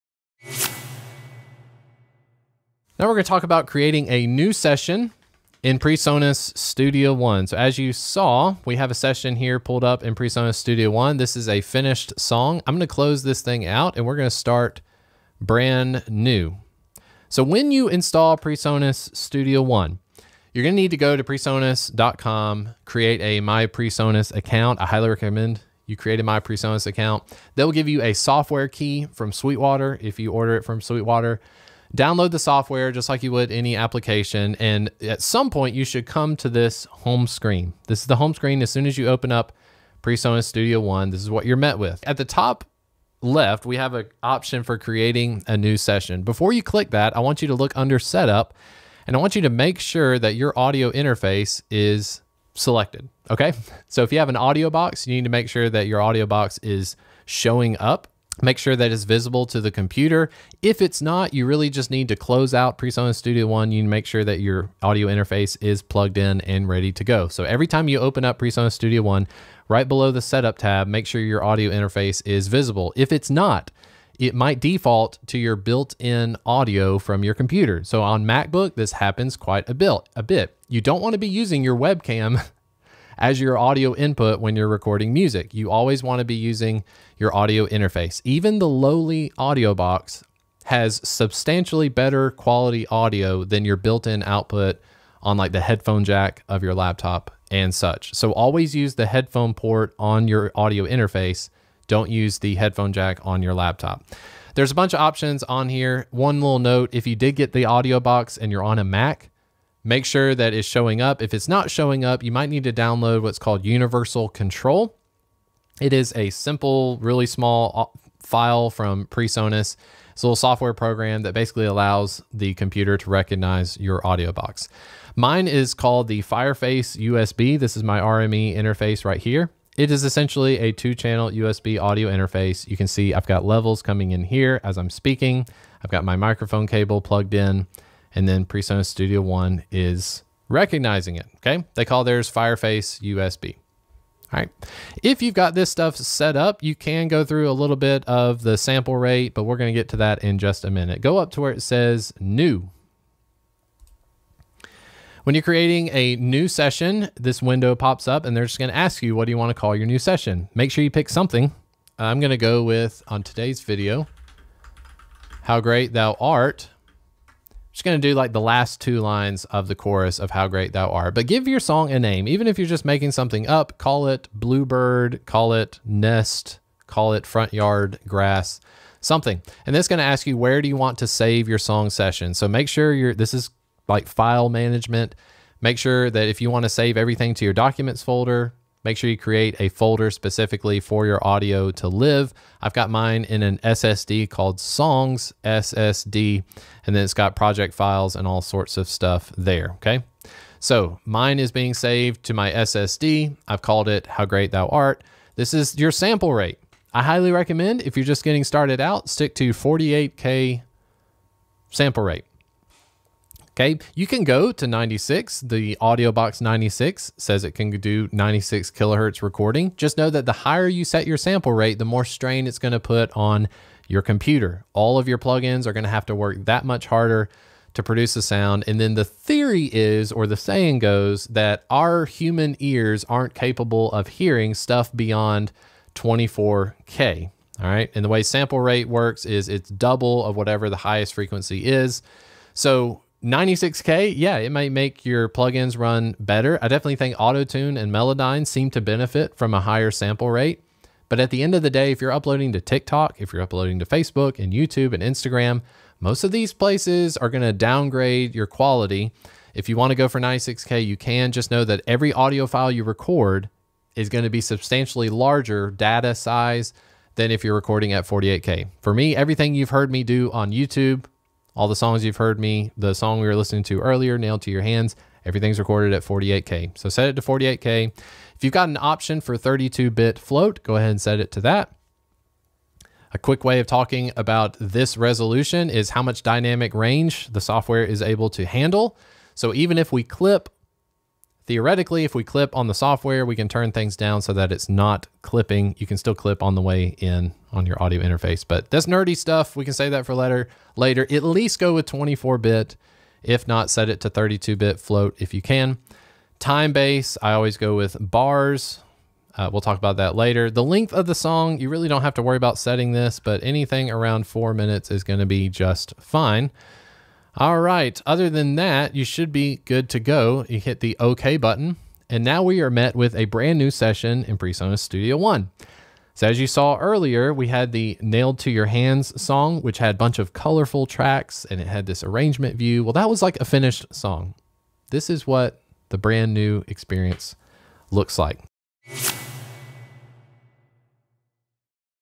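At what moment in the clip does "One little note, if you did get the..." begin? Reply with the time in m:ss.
1:46.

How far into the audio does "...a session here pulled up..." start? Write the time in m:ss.
0:08.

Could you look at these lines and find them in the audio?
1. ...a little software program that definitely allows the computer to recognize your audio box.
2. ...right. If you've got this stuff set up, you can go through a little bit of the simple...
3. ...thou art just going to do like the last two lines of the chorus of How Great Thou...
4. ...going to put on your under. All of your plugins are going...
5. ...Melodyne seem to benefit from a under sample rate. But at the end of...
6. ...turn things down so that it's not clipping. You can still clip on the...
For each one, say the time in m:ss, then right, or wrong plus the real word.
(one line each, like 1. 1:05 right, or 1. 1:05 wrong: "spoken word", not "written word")
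1. 2:00 wrong: "basically", not "definitely"
2. 2:24 wrong: "sample", not "simple"
3. 2:45 right
4. 3:42 wrong: "computer", not "under"
5. 4:07 wrong: "higher", not "under"
6. 4:53 right.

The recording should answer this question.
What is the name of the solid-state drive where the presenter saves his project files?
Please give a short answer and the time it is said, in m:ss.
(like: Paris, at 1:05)
Songs SSD, at 3:14.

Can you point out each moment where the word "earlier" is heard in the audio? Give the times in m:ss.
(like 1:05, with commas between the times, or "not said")
4:33, 5:26.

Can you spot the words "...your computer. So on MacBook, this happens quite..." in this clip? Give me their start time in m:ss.
1:17.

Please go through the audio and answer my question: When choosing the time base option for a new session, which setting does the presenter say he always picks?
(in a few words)
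bars.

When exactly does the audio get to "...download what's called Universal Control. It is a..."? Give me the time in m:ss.
1:52.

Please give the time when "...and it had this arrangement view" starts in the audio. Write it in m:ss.
5:31.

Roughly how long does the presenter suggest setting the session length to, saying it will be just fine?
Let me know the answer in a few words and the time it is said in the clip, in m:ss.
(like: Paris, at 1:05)
4 minutes, at 5:14.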